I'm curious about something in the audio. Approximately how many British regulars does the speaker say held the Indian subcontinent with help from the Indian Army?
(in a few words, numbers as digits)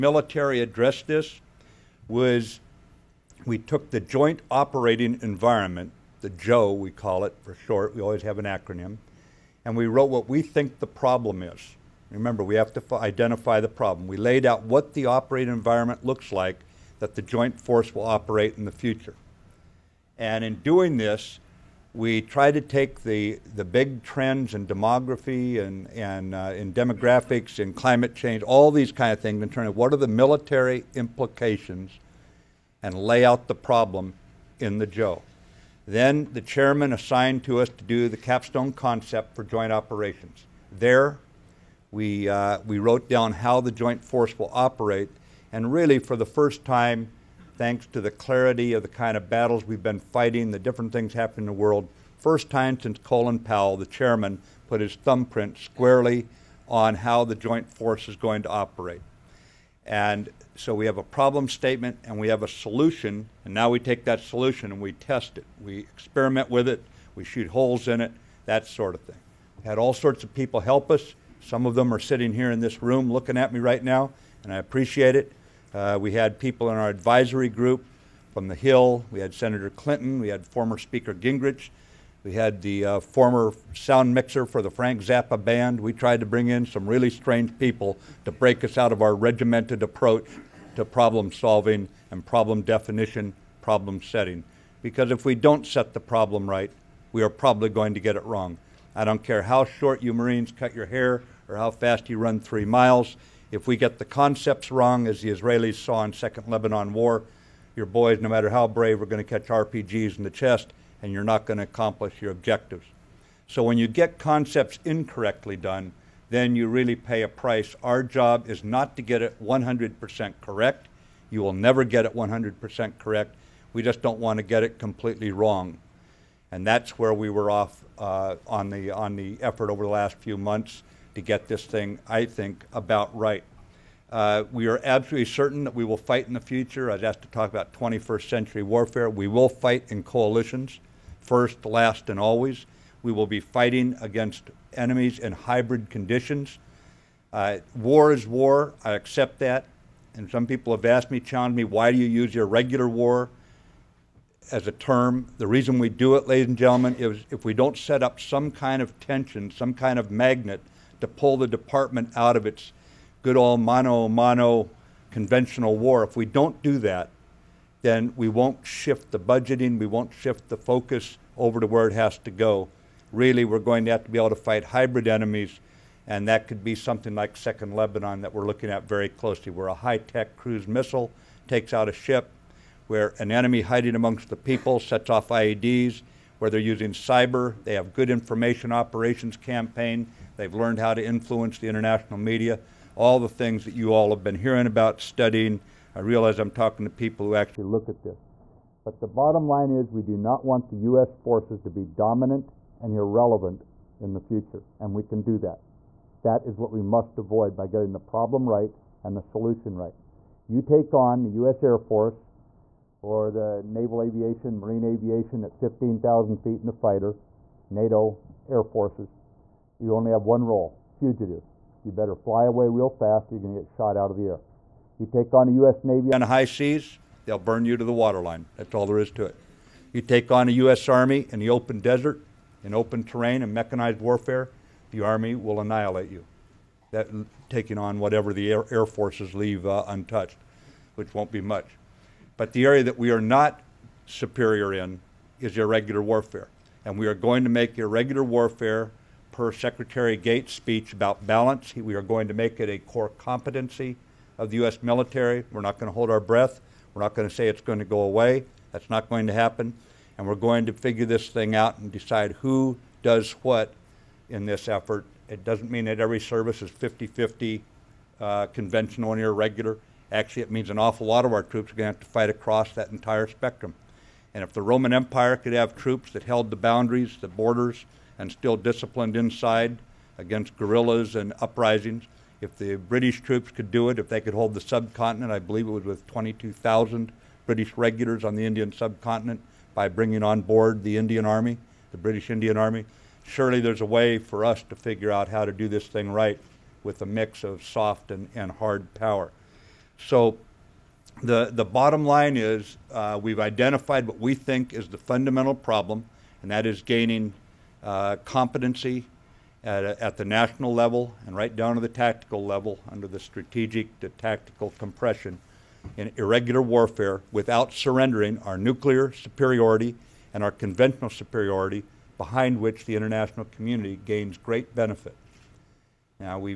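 22,000.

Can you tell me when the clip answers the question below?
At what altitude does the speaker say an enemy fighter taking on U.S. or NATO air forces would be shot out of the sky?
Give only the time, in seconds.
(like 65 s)
215 s.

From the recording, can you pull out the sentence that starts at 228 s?
That's all there is to it.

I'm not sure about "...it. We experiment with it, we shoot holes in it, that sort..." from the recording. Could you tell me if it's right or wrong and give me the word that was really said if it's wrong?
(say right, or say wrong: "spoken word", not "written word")
right.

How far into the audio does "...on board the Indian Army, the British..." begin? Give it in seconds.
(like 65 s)
290 s.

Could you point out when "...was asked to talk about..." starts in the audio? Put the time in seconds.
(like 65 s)
136 s.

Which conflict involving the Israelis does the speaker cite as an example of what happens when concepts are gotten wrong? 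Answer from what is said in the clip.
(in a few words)
Second Lebanon War.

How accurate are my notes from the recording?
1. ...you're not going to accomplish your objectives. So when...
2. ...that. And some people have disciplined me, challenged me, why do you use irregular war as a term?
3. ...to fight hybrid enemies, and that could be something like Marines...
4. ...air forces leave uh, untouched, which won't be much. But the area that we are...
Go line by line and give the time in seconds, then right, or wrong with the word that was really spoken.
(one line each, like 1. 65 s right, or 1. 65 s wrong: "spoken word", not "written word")
1. 111 s right
2. 149 s wrong: "asked", not "disciplined"
3. 174 s wrong: "Second", not "Marines"
4. 238 s right.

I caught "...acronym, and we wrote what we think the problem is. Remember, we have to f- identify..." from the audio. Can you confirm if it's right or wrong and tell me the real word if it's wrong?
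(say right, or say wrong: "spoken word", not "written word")
right.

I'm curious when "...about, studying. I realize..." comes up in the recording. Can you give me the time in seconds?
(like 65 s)
194 s.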